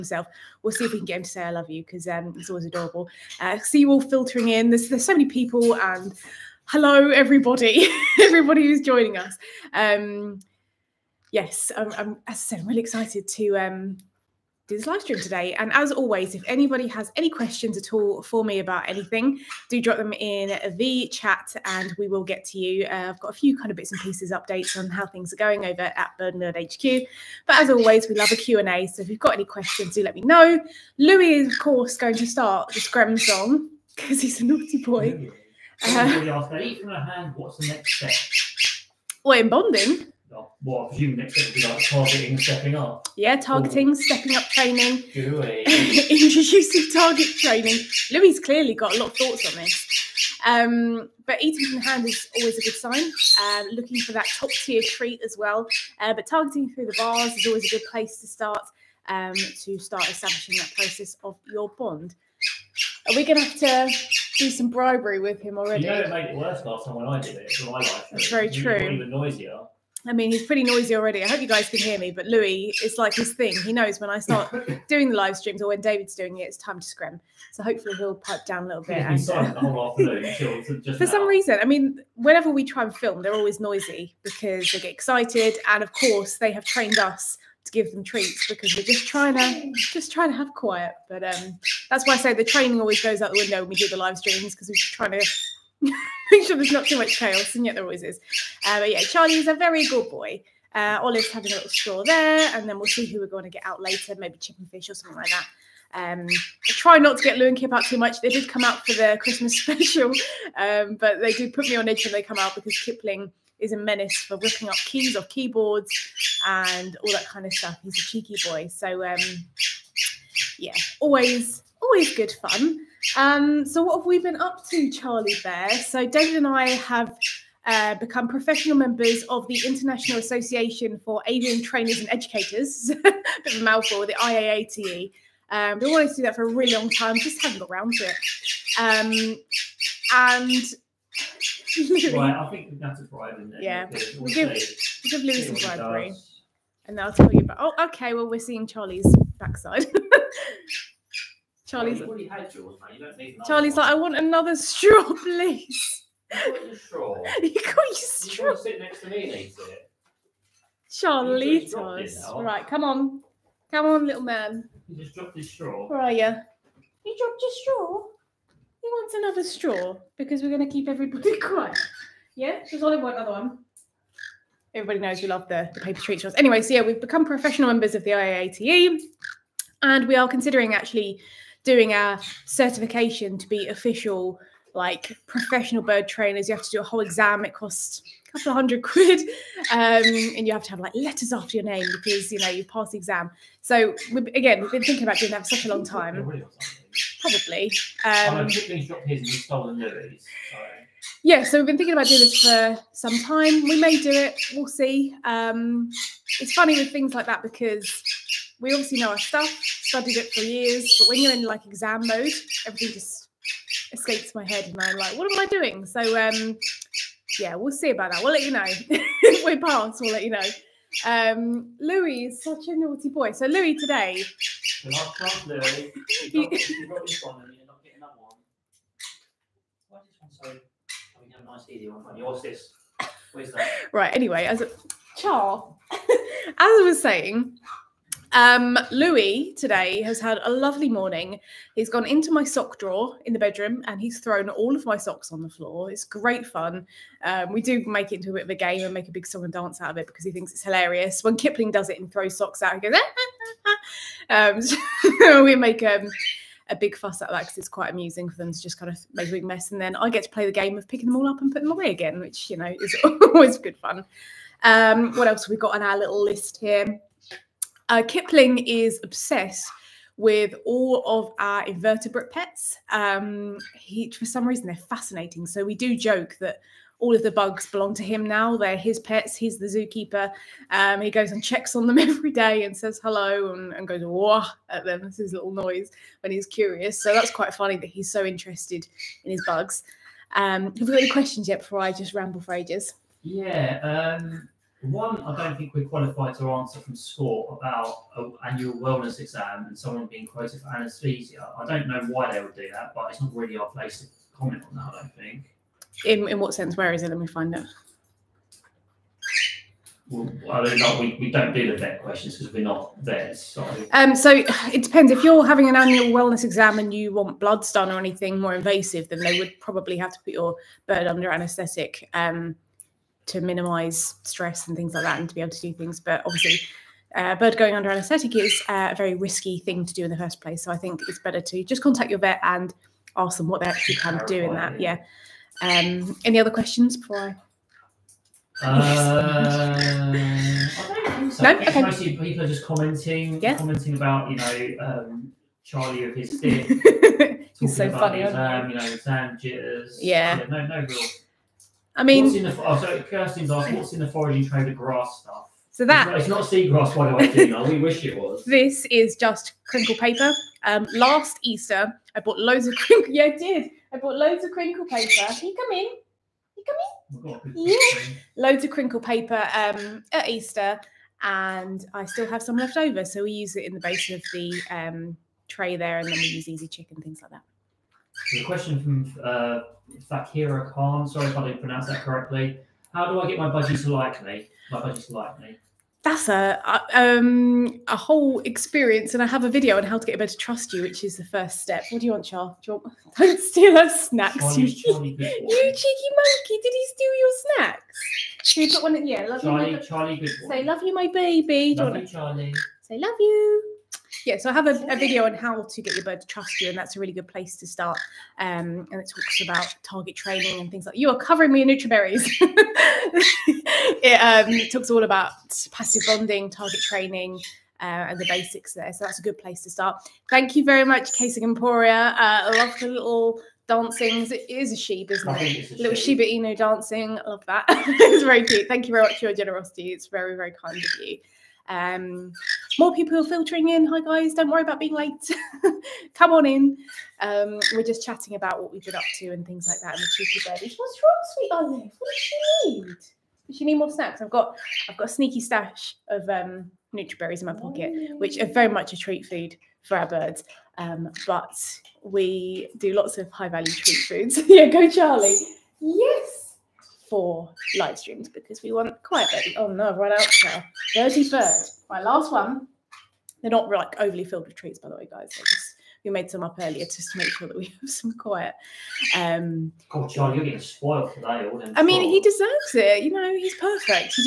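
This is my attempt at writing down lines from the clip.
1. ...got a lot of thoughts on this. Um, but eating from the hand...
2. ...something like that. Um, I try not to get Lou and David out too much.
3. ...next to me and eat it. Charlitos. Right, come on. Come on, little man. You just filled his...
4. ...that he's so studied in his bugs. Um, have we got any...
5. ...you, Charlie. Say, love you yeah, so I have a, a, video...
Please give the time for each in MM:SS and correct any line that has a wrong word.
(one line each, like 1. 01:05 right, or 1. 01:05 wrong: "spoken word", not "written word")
1. 00:48 right
2. 01:44 wrong: "Kip", not "David"
3. 02:38 wrong: "dropped", not "filled"
4. 04:47 wrong: "interested", not "studied"
5. 06:41 right.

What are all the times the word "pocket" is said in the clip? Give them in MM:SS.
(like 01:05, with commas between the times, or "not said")
07:27.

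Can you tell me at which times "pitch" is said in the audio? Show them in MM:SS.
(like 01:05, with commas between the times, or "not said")
not said.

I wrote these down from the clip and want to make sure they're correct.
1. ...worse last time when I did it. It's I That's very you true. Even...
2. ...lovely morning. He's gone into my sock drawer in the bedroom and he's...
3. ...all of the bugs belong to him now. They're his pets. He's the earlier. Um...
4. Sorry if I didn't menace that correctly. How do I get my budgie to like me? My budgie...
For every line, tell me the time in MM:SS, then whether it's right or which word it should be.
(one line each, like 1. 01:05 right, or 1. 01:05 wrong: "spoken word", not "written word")
1. 01:06 right
2. 04:00 right
3. 04:36 wrong: "zookeeper", not "earlier"
4. 06:21 wrong: "pronounce", not "menace".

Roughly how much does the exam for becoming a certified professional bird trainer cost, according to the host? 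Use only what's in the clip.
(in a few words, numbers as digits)
a couple of hundred quid.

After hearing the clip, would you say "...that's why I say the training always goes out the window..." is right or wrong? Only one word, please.
right.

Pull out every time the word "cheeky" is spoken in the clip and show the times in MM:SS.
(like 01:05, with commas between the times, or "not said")
01:58, 06:34, 07:20.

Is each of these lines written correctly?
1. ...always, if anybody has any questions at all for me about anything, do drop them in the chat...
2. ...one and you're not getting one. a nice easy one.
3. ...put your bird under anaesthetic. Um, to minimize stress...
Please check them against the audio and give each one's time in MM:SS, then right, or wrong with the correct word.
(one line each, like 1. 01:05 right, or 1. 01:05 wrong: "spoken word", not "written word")
1. 00:15 right
2. 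03:47 right
3. 05:20 right.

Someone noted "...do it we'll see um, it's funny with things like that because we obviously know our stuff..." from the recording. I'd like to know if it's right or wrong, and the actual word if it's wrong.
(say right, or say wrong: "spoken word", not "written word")
right.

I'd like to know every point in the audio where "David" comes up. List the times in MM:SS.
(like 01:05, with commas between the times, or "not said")
01:15, 02:06.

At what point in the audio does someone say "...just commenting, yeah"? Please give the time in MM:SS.
05:42.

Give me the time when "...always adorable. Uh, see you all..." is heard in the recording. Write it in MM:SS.
00:02.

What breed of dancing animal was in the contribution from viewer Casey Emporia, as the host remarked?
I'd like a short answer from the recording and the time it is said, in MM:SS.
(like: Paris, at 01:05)
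Shiba Inu, at 07:06.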